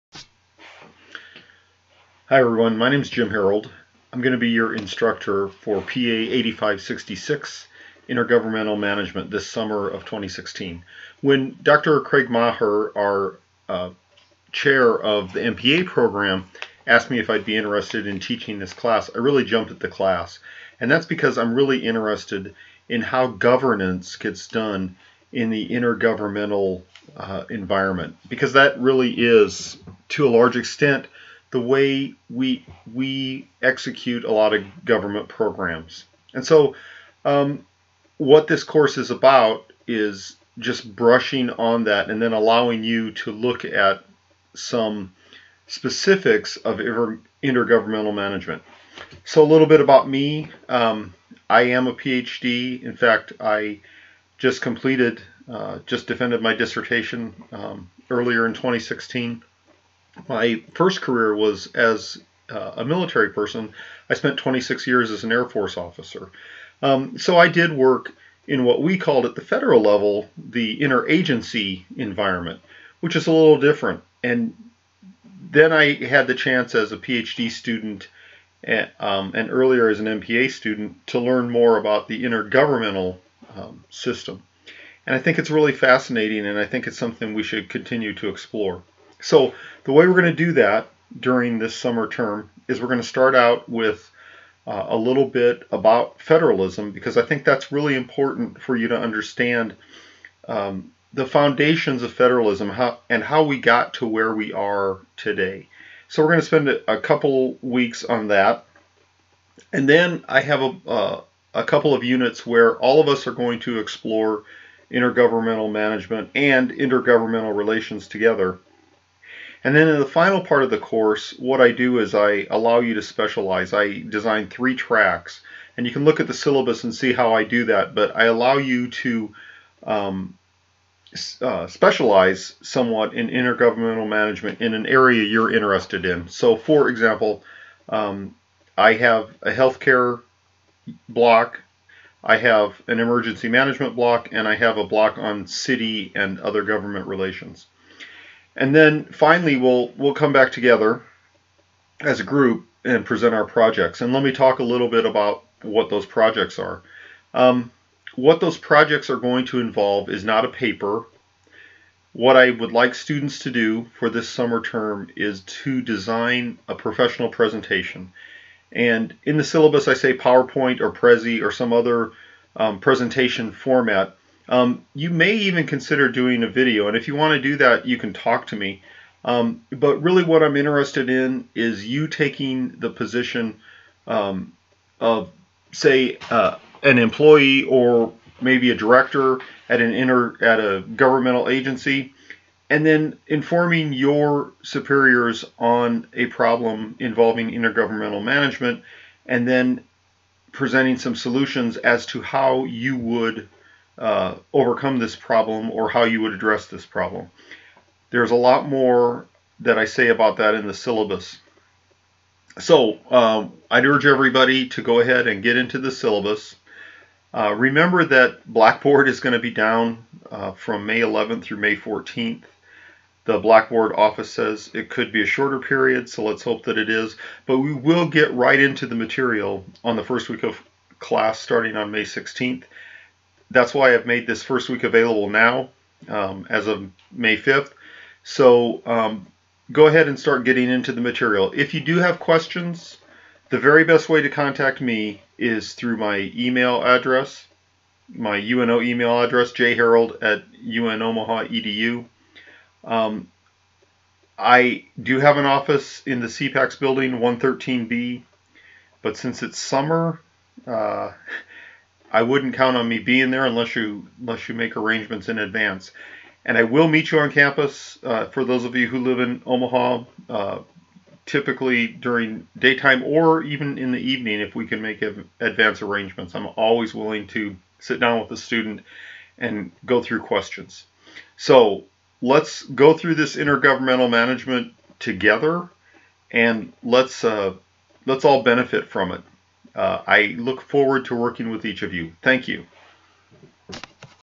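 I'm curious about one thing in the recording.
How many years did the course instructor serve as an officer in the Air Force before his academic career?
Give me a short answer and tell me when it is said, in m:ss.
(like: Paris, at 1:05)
26, at 1:04.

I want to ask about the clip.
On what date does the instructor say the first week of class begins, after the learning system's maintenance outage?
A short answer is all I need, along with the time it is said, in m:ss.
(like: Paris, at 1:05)
May 16th, at 3:51.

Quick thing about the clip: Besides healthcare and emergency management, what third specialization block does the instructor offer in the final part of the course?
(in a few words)
City and other government relations.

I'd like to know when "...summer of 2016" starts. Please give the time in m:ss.
0:09.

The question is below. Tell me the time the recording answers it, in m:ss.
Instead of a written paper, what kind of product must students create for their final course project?
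2:46.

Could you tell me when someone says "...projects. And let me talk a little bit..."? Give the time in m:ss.
2:33.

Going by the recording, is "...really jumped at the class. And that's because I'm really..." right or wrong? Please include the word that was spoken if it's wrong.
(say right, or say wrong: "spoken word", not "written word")
right.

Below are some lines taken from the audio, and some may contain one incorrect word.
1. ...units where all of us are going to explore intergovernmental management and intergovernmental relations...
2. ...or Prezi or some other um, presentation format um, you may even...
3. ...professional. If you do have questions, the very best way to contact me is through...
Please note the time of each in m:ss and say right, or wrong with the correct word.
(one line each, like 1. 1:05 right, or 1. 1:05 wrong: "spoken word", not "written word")
1. 1:52 right
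2. 2:50 right
3. 4:01 wrong: "material", not "professional".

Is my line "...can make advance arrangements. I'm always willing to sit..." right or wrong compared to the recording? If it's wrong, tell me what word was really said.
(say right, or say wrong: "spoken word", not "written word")
right.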